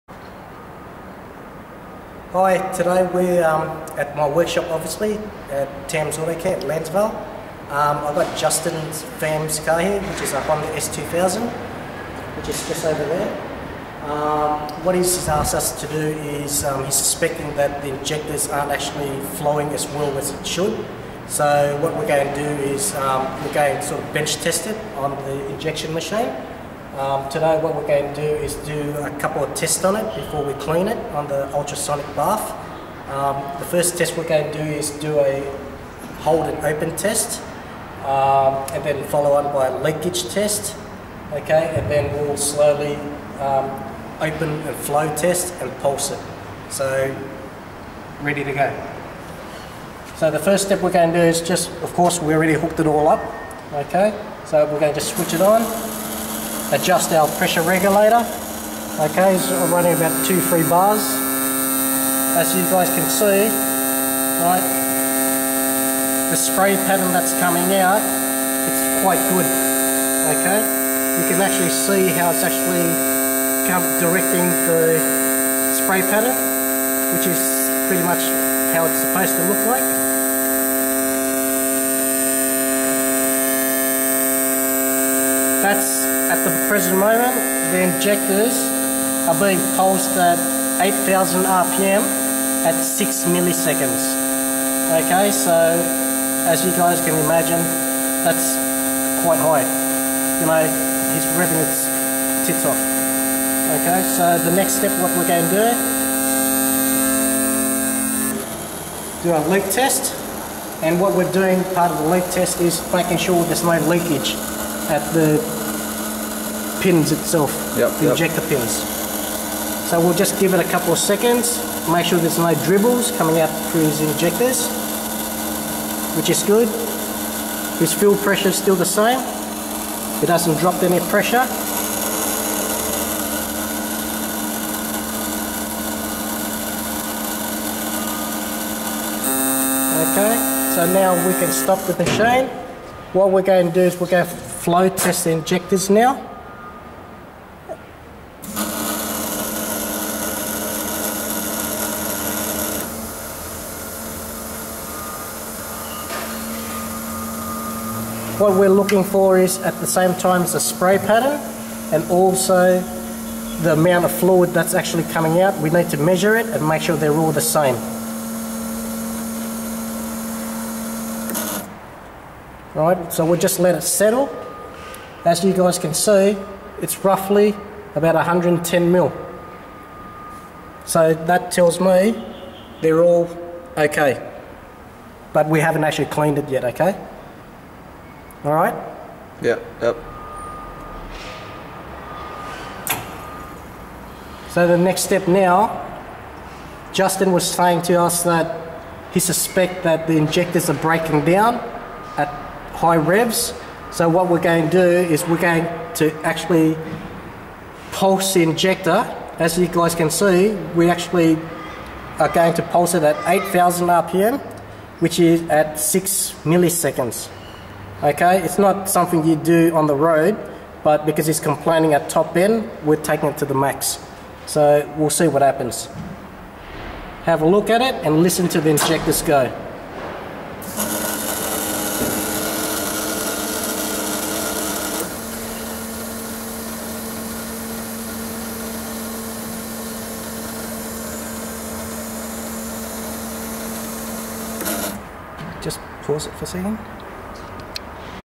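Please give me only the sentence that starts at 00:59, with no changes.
Okay, so are running about two, three bars.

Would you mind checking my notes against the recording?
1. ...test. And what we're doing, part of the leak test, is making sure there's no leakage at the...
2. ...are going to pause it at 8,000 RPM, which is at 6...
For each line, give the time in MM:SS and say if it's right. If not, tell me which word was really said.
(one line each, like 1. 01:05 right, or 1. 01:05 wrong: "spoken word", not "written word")
1. 01:49 right
2. 03:32 wrong: "pulse", not "pause".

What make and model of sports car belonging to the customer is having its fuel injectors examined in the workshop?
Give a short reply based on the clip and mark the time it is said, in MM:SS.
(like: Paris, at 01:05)
Honda S2000, at 00:10.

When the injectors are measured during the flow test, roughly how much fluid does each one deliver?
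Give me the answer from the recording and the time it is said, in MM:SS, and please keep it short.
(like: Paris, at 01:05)
110 ml, at 02:58.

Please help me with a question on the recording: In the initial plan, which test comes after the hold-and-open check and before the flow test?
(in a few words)
leakage test.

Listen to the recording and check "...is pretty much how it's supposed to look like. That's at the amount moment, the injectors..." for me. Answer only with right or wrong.
wrong.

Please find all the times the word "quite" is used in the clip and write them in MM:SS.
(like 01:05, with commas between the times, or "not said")
01:09, 01:39.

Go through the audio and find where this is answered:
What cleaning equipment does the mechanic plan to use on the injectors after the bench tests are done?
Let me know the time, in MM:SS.
00:31.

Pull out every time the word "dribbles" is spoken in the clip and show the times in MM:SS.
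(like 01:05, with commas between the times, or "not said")
02:02.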